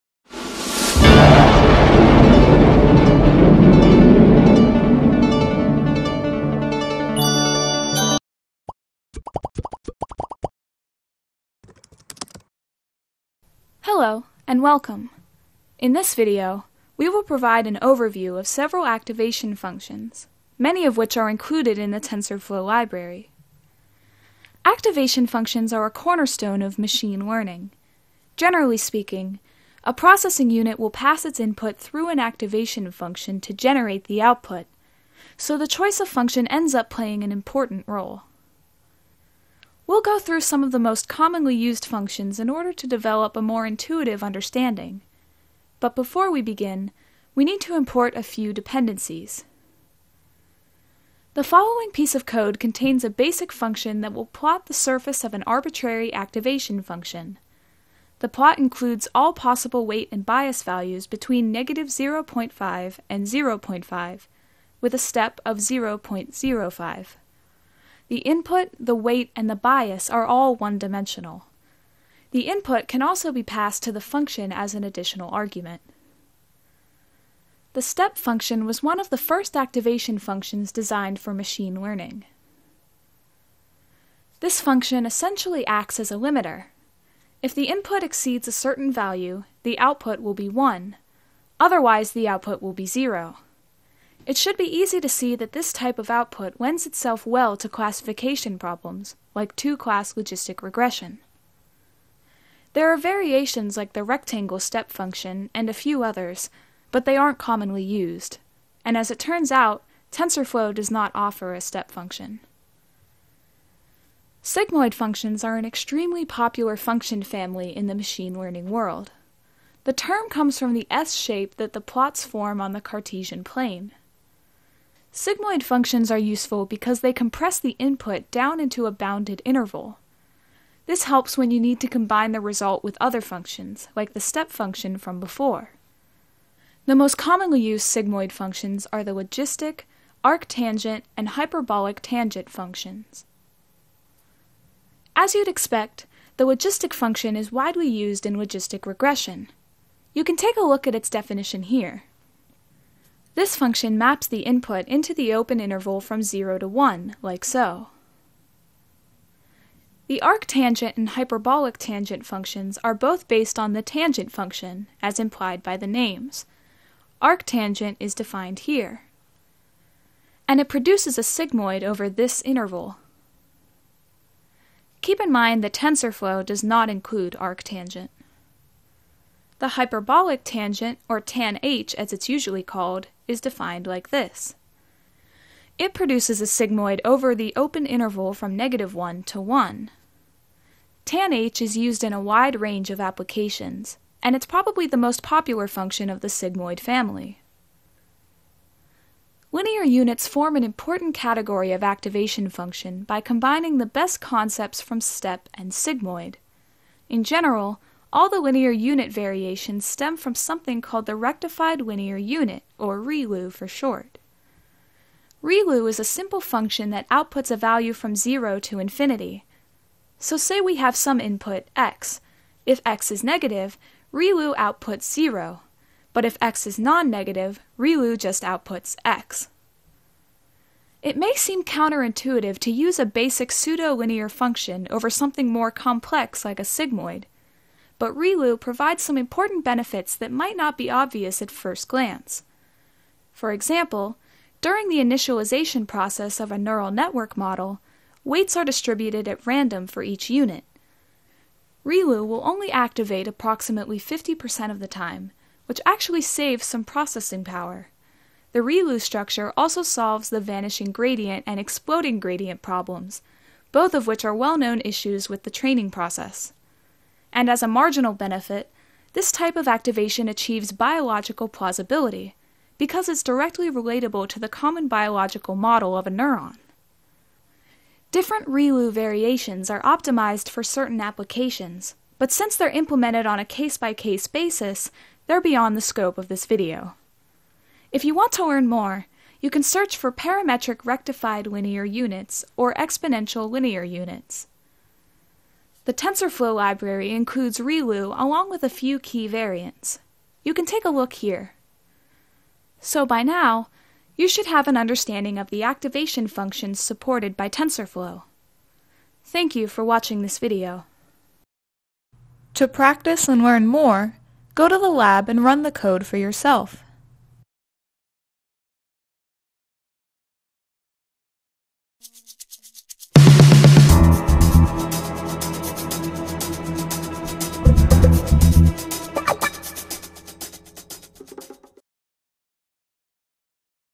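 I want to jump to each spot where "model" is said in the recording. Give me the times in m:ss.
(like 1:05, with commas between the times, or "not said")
4:07, 4:35.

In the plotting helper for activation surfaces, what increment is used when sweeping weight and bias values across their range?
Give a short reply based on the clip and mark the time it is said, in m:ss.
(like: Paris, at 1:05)
0.05, at 1:05.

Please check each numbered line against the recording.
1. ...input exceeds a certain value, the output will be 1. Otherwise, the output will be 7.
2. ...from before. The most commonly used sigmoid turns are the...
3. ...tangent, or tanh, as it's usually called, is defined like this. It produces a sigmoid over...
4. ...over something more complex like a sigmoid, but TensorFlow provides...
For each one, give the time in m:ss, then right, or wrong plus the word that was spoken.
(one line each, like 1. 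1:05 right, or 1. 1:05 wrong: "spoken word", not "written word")
1. 1:27 wrong: "0", not "7"
2. 2:14 wrong: "functions", not "turns"
3. 3:00 right
4. 3:54 wrong: "ReLU", not "TensorFlow".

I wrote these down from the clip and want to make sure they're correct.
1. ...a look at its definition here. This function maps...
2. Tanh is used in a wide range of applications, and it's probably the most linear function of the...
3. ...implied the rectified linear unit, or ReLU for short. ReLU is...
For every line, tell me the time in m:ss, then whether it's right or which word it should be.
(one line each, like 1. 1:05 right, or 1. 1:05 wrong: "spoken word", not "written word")
1. 2:30 right
2. 3:11 wrong: "popular", not "linear"
3. 3:30 wrong: "called", not "implied".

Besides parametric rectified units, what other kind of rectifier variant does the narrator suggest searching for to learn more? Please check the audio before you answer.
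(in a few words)
exponential linear units.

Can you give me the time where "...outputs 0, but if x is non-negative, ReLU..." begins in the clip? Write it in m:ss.
3:44.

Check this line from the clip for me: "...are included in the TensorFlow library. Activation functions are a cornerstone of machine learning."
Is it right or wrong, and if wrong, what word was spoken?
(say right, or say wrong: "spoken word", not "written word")
right.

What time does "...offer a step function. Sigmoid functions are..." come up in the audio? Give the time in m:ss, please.
1:51.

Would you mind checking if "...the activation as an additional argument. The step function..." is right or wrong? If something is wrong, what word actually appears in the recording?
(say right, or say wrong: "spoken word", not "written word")
wrong: "function", not "activation".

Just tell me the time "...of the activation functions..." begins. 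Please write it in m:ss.
5:05.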